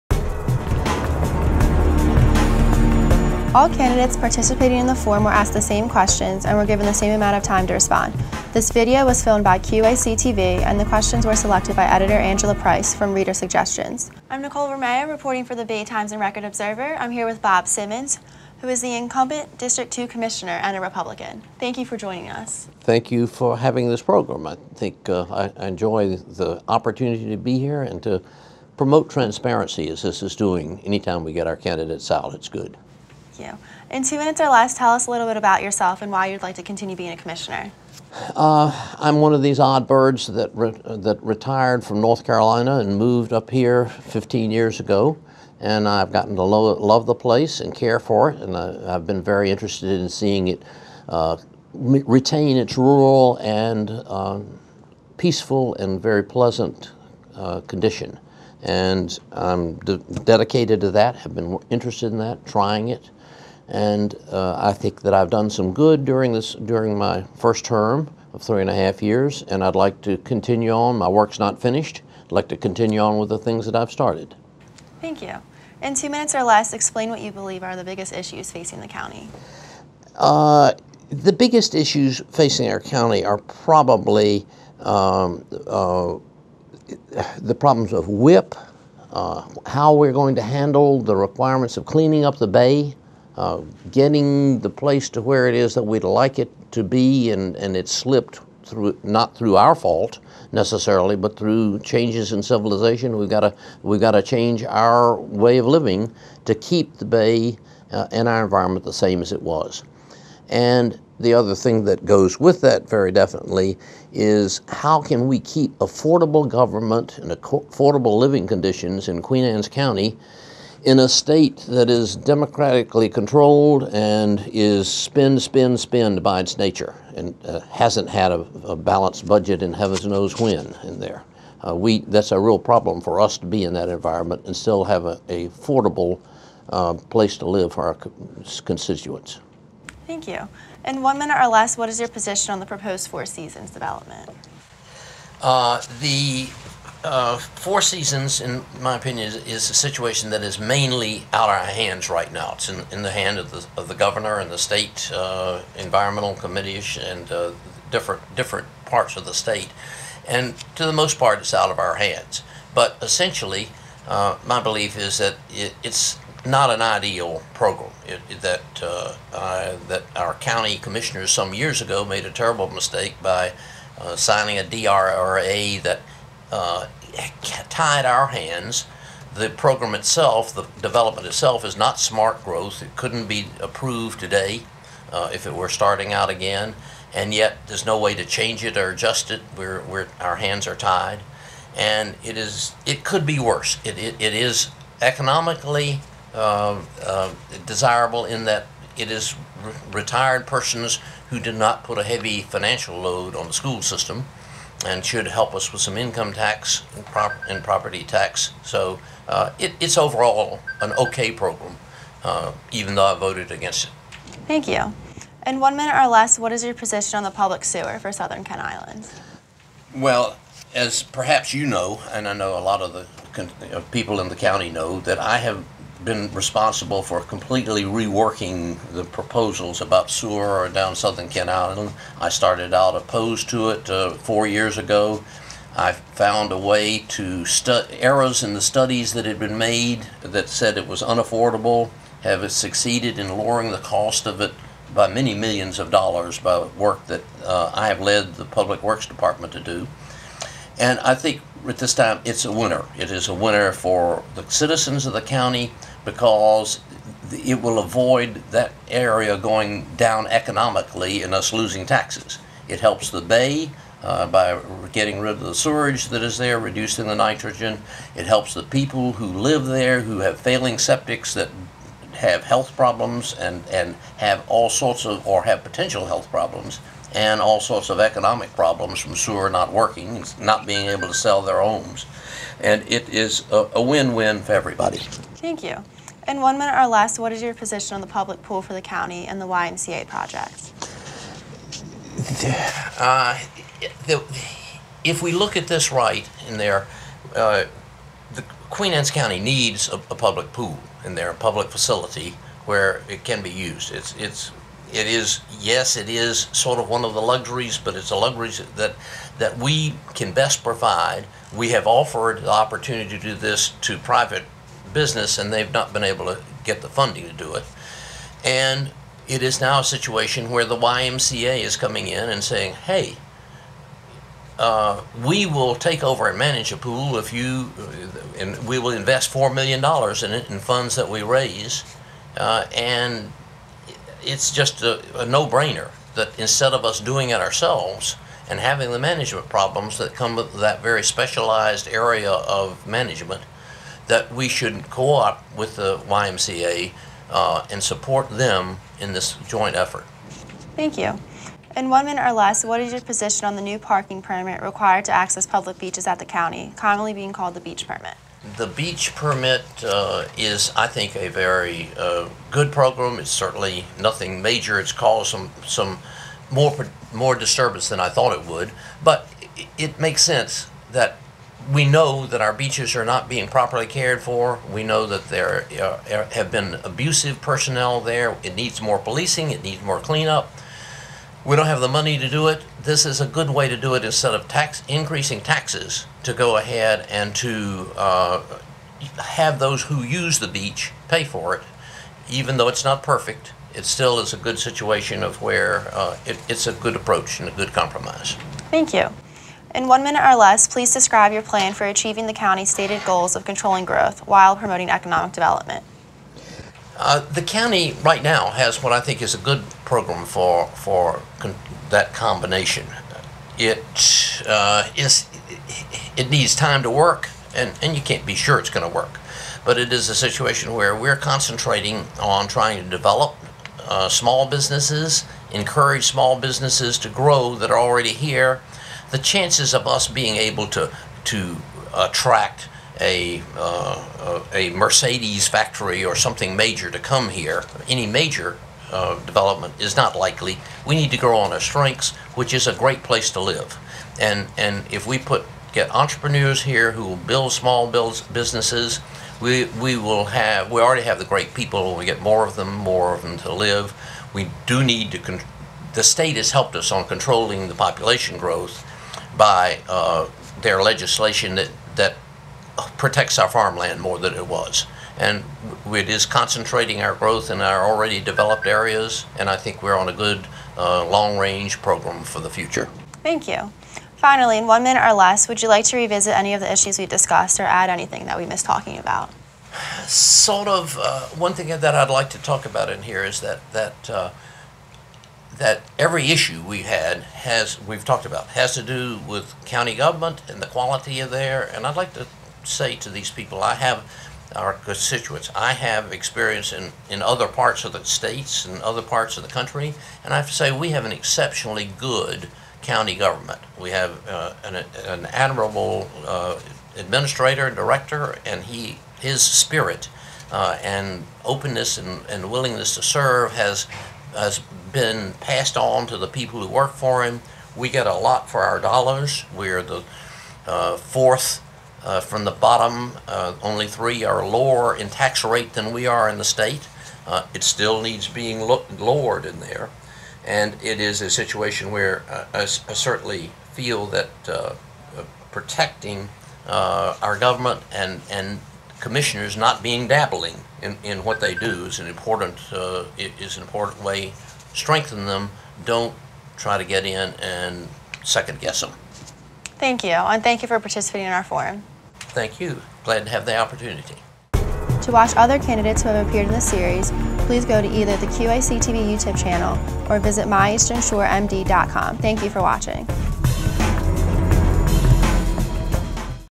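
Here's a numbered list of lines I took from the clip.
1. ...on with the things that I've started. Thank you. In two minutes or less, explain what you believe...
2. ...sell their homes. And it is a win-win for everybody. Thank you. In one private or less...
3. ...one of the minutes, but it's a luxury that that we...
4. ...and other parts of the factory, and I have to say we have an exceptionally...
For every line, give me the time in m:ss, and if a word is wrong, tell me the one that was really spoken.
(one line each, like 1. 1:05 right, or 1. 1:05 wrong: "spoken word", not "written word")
1. 1:12 right
2. 4:41 wrong: "minute", not "private"
3. 5:06 wrong: "luxuries", not "minutes"
4. 8:18 wrong: "country", not "factory".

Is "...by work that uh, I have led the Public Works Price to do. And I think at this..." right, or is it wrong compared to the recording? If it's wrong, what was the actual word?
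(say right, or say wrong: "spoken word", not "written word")
wrong: "Department", not "Price".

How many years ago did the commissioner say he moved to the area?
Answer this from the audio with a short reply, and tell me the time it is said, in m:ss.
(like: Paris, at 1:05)
15 years, at 0:43.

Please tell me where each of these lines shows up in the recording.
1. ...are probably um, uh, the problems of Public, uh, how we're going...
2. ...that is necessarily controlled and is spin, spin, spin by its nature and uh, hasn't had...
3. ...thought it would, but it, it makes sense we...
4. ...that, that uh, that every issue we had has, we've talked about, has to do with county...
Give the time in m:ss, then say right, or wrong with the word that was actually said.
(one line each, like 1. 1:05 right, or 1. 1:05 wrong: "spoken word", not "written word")
1. 1:23 wrong: "WIP", not "Public"
2. 2:01 wrong: "democratically", not "necessarily"
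3. 6:08 right
4. 8:03 right.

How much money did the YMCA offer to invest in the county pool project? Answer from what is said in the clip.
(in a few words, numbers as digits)
$4 million.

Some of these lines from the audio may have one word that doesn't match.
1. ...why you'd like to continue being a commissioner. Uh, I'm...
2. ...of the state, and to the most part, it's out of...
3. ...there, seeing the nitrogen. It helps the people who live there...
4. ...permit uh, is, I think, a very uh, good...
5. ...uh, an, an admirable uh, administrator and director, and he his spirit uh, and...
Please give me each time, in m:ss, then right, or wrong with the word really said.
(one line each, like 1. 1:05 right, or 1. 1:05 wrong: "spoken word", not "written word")
1. 0:36 right
2. 2:39 right
3. 4:26 wrong: "reducing", not "seeing"
4. 5:59 right
5. 8:24 right.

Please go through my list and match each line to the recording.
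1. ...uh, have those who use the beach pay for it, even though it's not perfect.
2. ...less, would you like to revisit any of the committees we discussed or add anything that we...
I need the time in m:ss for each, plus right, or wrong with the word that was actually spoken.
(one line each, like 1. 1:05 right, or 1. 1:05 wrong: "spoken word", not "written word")
1. 6:27 right
2. 7:55 wrong: "issues", not "committees".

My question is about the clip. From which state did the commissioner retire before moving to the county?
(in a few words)
North Carolina.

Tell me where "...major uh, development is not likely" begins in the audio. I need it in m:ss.
7:18.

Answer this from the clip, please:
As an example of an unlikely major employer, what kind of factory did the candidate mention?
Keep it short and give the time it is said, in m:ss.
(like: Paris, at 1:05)
Mercedes factory, at 7:14.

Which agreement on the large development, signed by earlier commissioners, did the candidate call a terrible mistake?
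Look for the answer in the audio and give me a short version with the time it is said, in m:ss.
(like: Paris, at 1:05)
DRRA, at 2:54.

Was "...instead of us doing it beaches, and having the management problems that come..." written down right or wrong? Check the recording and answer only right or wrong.
wrong.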